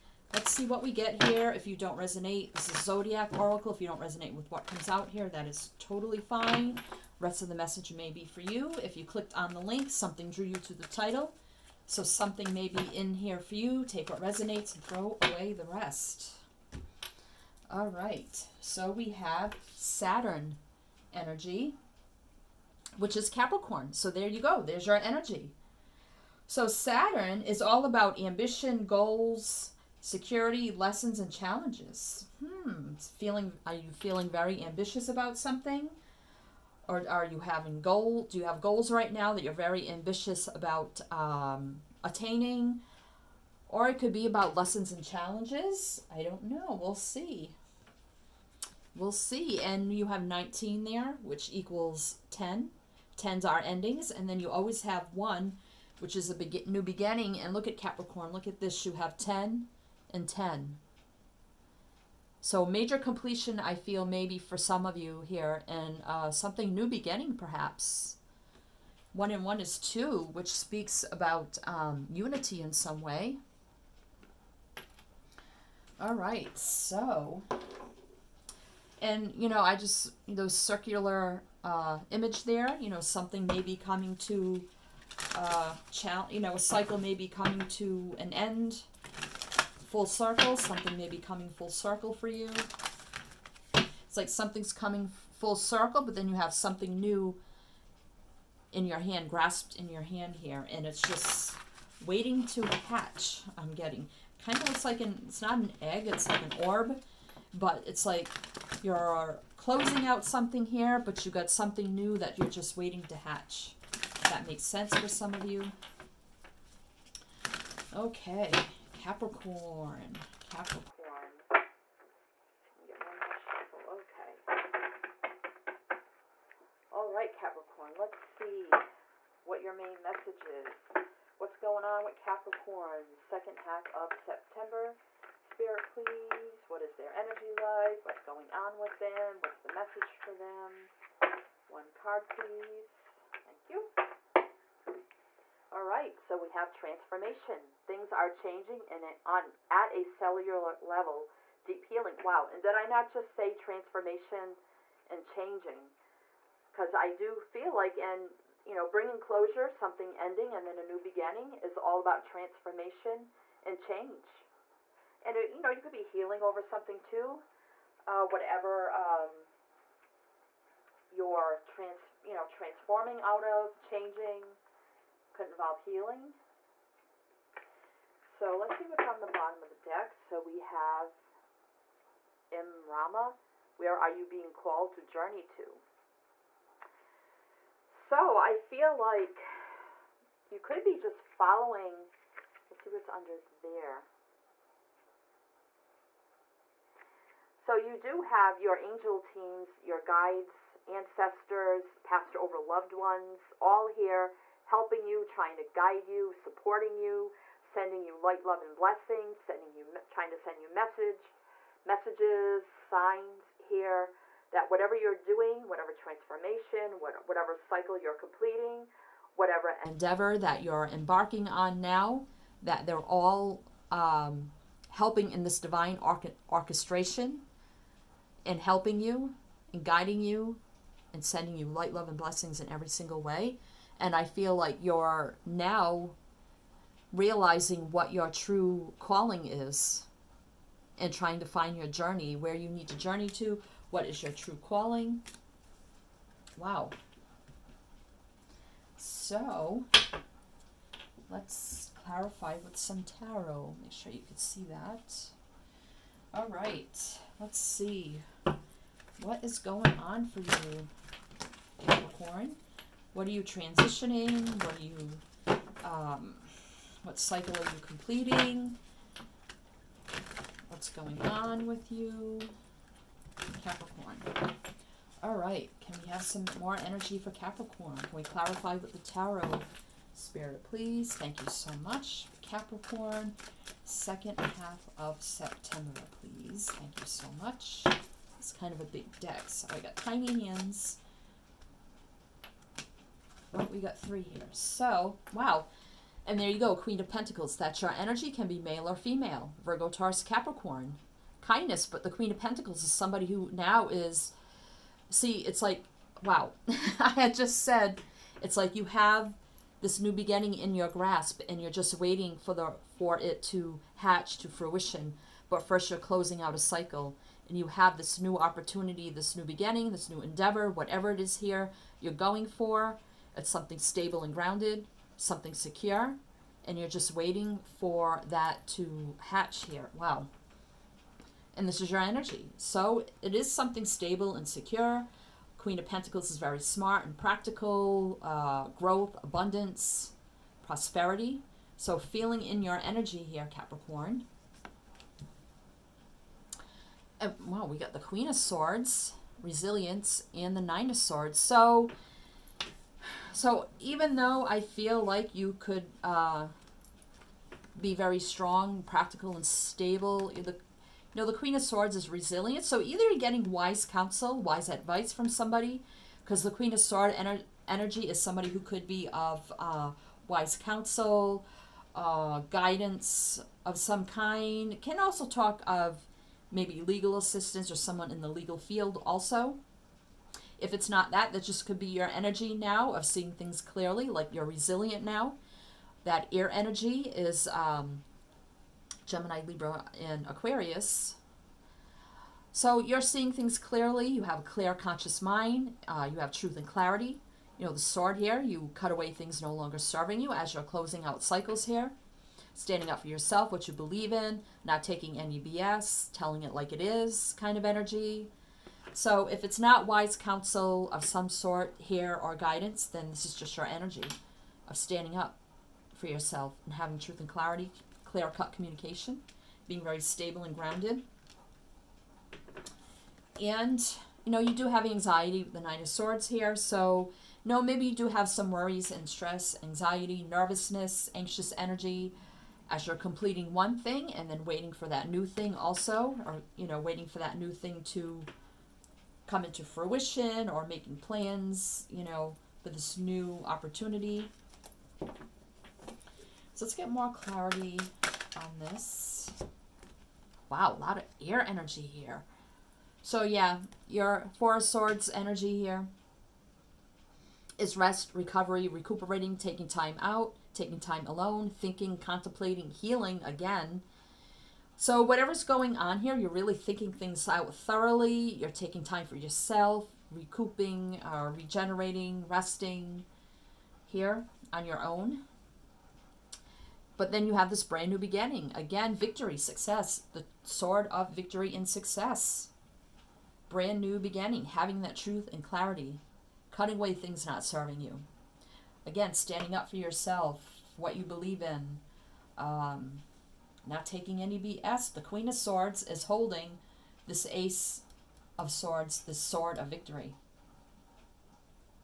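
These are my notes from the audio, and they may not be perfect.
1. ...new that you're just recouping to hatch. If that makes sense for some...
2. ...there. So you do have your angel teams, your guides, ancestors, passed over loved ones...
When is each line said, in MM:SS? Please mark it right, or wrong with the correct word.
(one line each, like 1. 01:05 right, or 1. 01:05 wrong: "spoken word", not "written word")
1. 01:51 wrong: "waiting", not "recouping"
2. 03:13 right.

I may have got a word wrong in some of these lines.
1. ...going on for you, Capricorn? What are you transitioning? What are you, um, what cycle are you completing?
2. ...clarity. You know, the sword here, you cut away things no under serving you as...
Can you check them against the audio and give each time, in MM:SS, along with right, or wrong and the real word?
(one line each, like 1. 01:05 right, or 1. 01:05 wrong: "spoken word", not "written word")
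1. 04:19 right
2. 06:36 wrong: "longer", not "under".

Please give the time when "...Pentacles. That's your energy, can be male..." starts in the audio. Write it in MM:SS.
04:57.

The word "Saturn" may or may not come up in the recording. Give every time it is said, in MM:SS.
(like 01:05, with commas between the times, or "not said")
00:19, 00:26.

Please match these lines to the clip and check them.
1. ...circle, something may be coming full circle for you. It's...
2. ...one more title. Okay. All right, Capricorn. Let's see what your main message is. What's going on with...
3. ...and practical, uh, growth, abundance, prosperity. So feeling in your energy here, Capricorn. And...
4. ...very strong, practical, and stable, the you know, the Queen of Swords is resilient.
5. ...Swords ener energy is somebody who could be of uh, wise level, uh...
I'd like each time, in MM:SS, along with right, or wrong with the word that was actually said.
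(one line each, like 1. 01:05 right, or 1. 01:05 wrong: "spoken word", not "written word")
1. 01:30 right
2. 02:03 wrong: "shuffle", not "title"
3. 05:37 right
4. 05:57 right
5. 06:06 wrong: "counsel", not "level".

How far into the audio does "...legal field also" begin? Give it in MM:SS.
06:18.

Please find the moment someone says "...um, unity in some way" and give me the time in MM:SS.
01:11.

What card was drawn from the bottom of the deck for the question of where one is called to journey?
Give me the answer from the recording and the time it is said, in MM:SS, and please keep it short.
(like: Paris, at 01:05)
Imrama, at 03:02.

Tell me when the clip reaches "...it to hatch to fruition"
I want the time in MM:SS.
05:13.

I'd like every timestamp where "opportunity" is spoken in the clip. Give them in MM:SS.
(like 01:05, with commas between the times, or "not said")
05:18, 07:23.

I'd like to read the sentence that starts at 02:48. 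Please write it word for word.
Uh, whatever um, you're trans, you know, transforming out of, changing could involve healing.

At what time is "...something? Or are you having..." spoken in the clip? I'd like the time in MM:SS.
00:35.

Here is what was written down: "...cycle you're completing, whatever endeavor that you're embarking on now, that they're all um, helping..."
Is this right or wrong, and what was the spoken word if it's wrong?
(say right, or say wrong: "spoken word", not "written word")
right.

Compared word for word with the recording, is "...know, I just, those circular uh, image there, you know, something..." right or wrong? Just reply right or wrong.
right.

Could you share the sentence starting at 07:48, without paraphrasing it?
You're taking time for yourself, recouping, uh, regenerating, resting here on your own.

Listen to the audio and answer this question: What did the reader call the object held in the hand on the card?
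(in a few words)
An orb.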